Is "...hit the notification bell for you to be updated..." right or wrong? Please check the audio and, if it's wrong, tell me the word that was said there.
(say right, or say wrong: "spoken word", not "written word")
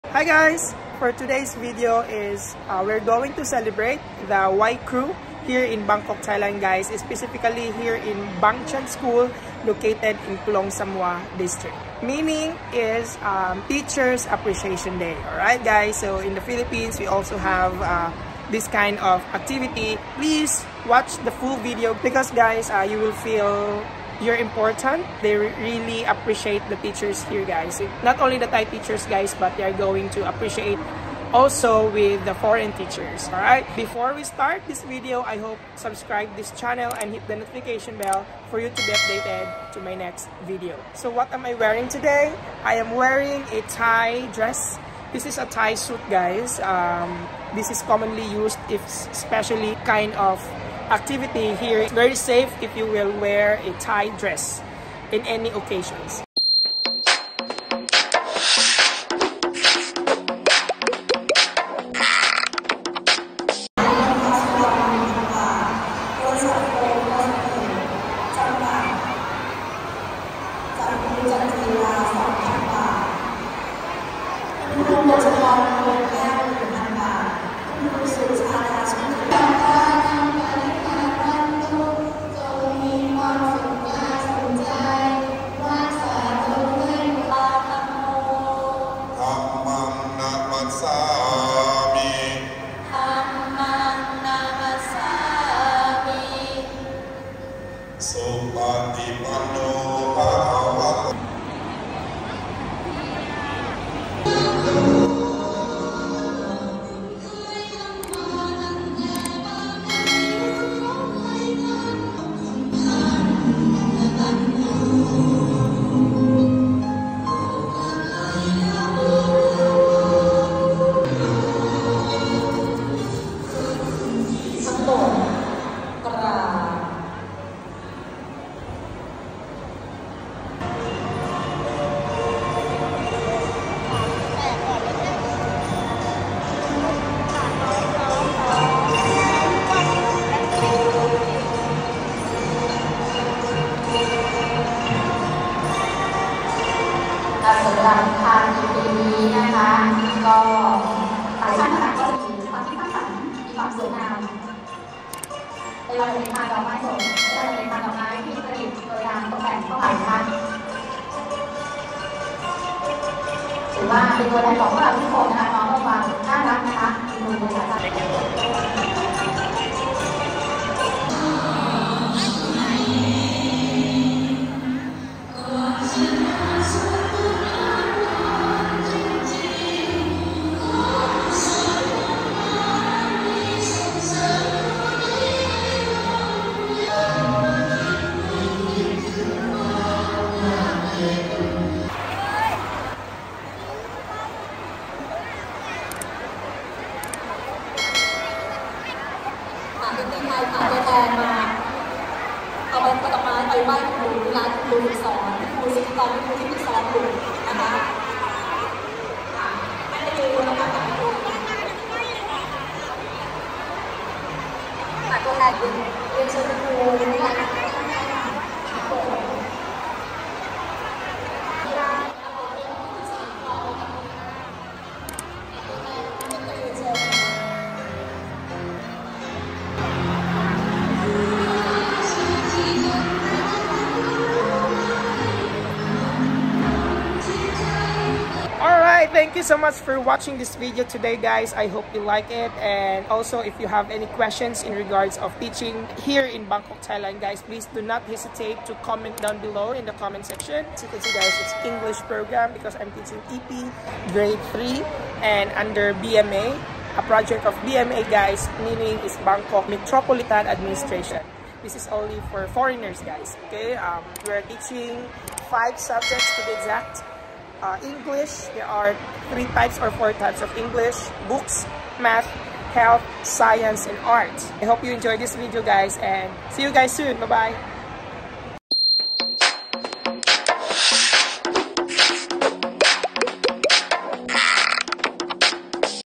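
right.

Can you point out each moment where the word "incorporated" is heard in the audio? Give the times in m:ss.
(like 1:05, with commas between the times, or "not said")
not said.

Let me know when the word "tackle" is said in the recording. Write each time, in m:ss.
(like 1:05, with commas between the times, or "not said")
not said.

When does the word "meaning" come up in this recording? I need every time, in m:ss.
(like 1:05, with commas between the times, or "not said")
0:12, 4:18.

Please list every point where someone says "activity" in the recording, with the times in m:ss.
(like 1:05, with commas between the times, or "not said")
0:19, 0:50.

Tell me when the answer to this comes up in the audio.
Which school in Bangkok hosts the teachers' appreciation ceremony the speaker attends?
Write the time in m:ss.
0:08.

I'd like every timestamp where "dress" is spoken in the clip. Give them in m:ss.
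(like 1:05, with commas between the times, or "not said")
0:44, 0:54.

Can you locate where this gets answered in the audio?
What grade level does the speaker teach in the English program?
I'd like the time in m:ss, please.
4:14.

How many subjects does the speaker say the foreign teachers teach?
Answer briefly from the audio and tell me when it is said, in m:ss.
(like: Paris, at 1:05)
5, at 4:25.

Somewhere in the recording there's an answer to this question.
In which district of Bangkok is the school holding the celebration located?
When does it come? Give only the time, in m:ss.
0:10.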